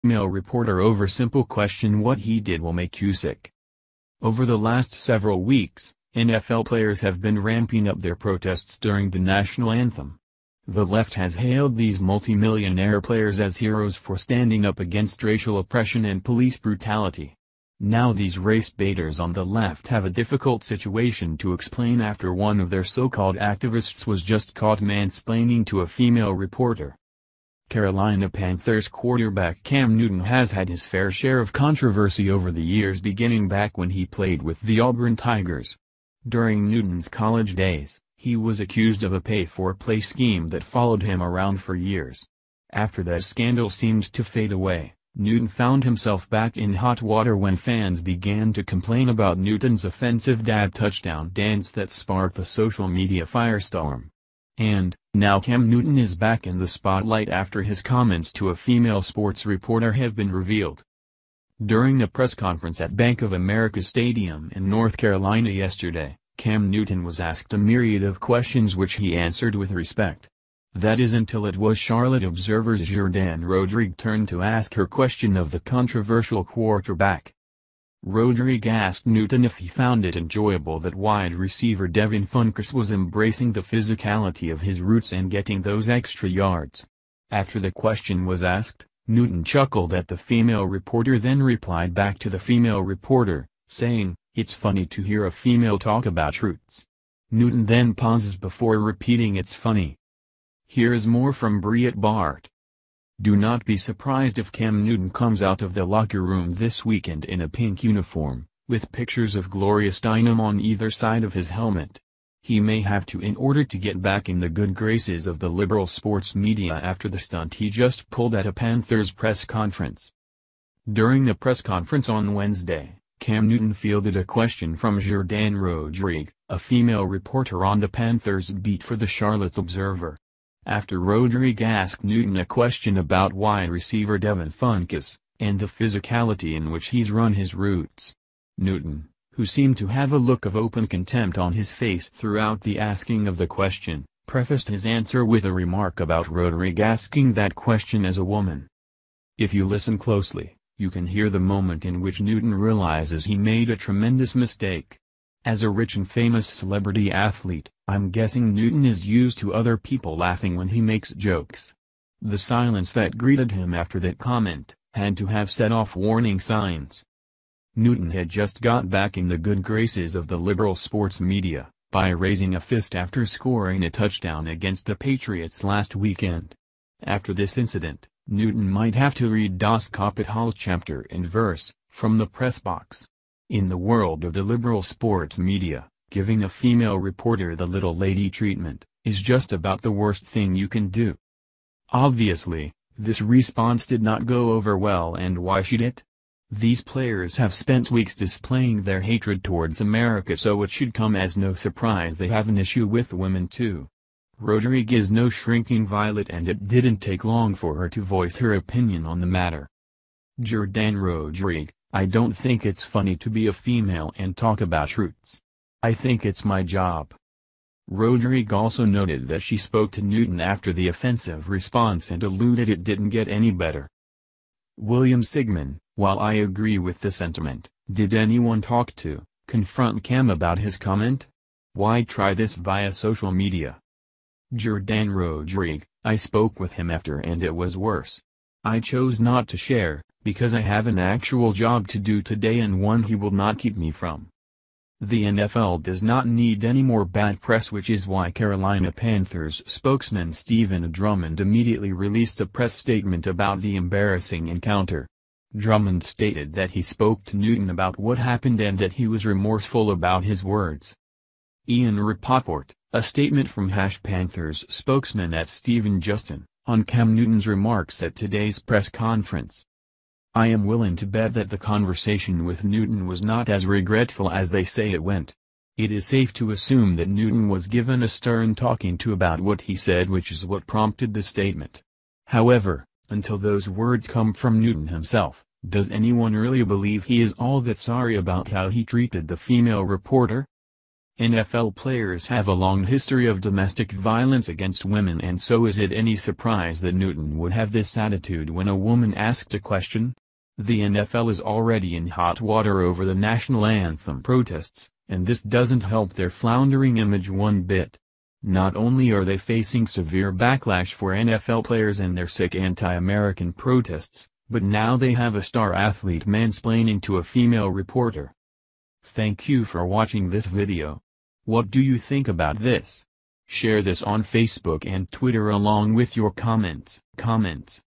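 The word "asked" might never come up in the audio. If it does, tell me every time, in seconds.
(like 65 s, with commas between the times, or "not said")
67 s, 78 s, 88 s, 131 s, 299 s.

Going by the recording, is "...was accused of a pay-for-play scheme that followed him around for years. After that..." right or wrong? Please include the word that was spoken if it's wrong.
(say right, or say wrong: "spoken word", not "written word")
right.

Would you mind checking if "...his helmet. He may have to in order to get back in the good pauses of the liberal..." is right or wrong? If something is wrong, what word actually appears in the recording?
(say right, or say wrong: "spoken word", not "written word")
wrong: "graces", not "pauses".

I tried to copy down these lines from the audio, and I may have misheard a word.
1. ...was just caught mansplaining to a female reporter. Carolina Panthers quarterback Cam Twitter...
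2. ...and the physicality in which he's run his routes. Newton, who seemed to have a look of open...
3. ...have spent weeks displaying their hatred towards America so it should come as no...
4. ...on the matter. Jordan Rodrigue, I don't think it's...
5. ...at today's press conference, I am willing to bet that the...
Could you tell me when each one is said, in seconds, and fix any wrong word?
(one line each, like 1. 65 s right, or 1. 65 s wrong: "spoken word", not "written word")
1. 24 s wrong: "Newton", not "Twitter"
2. 135 s right
3. 197 s right
4. 209 s right
5. 268 s right.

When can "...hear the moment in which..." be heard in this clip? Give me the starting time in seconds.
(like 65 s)
151 s.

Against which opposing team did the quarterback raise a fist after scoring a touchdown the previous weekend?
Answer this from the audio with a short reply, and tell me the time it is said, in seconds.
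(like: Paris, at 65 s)
Patriots, at 174 s.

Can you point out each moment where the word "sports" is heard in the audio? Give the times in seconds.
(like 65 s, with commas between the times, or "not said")
59 s, 115 s, 170 s, 184 s.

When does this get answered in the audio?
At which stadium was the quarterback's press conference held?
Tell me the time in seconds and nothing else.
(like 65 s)
62 s.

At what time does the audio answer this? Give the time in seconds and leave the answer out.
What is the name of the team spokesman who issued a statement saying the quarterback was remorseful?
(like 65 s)
250 s.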